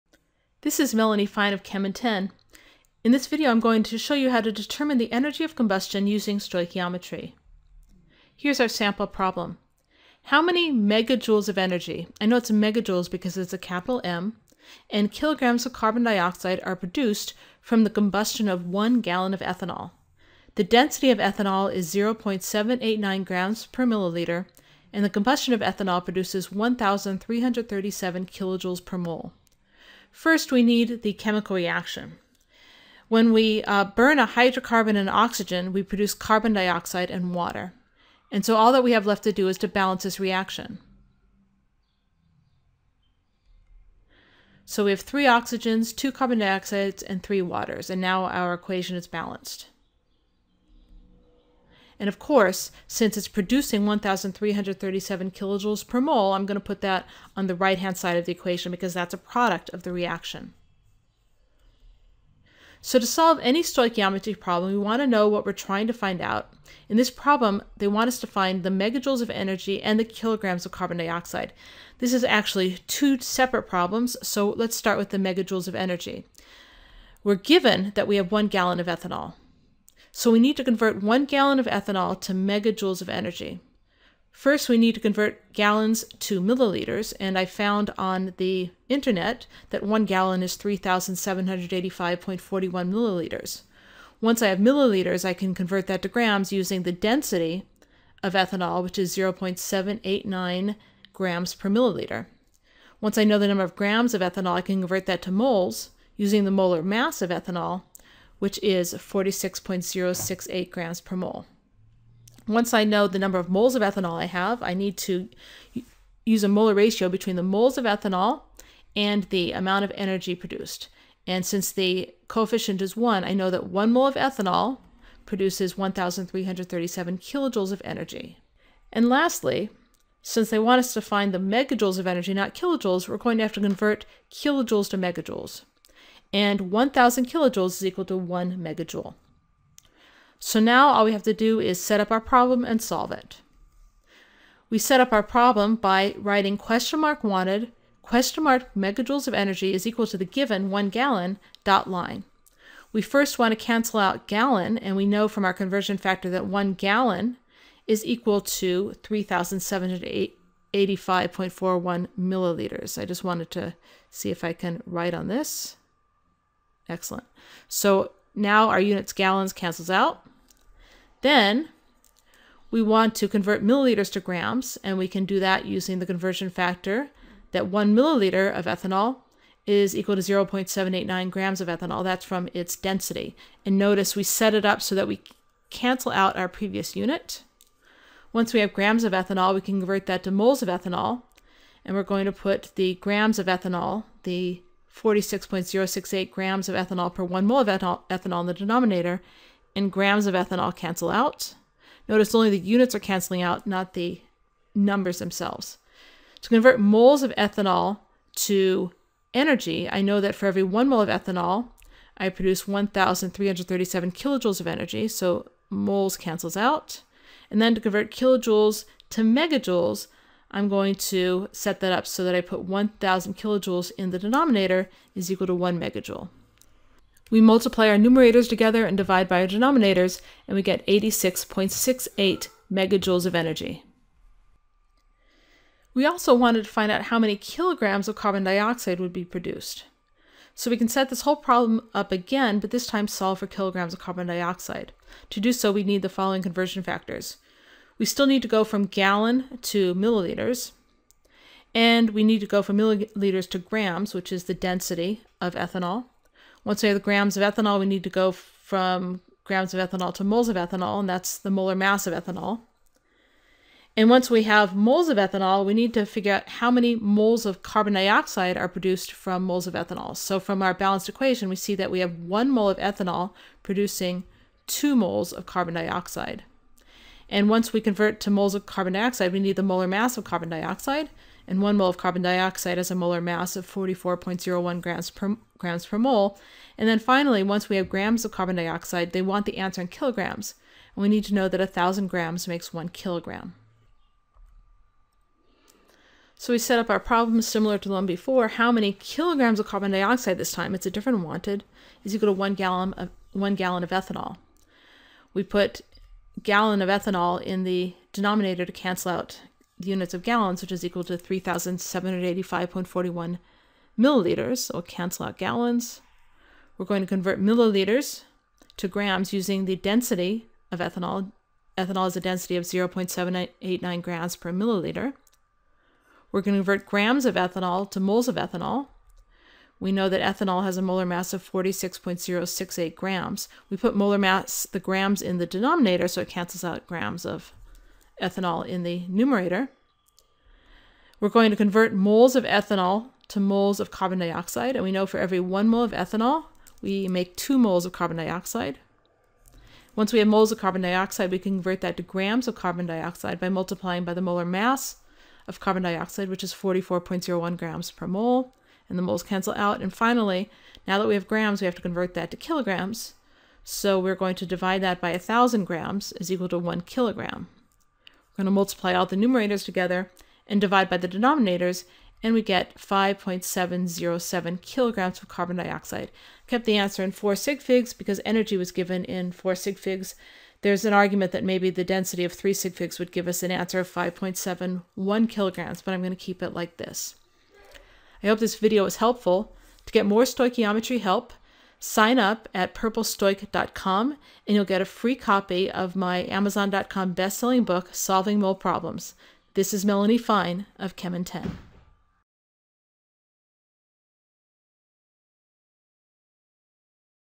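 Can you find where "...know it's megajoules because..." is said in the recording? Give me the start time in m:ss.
0:12.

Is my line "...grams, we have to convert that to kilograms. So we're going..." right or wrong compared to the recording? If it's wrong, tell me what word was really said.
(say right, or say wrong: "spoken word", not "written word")
right.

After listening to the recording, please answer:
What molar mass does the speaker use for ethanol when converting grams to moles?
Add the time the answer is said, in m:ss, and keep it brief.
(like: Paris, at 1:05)
46.068 grams per mole, at 1:48.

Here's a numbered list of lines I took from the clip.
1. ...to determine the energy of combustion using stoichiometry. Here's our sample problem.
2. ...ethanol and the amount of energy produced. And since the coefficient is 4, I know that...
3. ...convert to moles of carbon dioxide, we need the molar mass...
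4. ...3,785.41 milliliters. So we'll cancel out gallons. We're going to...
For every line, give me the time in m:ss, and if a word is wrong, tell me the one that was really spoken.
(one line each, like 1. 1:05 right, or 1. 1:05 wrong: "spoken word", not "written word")
1. 0:04 right
2. 1:57 wrong: "1", not "4"
3. 4:37 right
4. 5:11 right.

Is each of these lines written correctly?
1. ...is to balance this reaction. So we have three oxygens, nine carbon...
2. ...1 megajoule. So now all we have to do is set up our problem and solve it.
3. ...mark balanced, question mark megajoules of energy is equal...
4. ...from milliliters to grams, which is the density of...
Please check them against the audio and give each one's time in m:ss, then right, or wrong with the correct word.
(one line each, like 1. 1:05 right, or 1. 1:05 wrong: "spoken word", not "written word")
1. 0:39 wrong: "two", not "nine"
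2. 2:18 right
3. 2:27 wrong: "wanted", not "balanced"
4. 4:12 right.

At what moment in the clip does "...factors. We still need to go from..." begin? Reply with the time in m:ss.
4:06.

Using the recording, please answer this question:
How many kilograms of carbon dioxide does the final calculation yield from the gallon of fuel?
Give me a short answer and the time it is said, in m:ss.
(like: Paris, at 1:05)
5.707 kilograms, at 6:12.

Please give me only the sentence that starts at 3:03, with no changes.
And notice we set it up so that we cancel out our previous unit.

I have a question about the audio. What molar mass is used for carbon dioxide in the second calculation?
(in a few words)
44.01 grams per mole.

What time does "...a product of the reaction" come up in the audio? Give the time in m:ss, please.
0:59.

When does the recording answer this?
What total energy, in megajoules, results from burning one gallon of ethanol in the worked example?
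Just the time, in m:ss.
3:50.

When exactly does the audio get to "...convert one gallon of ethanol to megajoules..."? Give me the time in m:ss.
1:20.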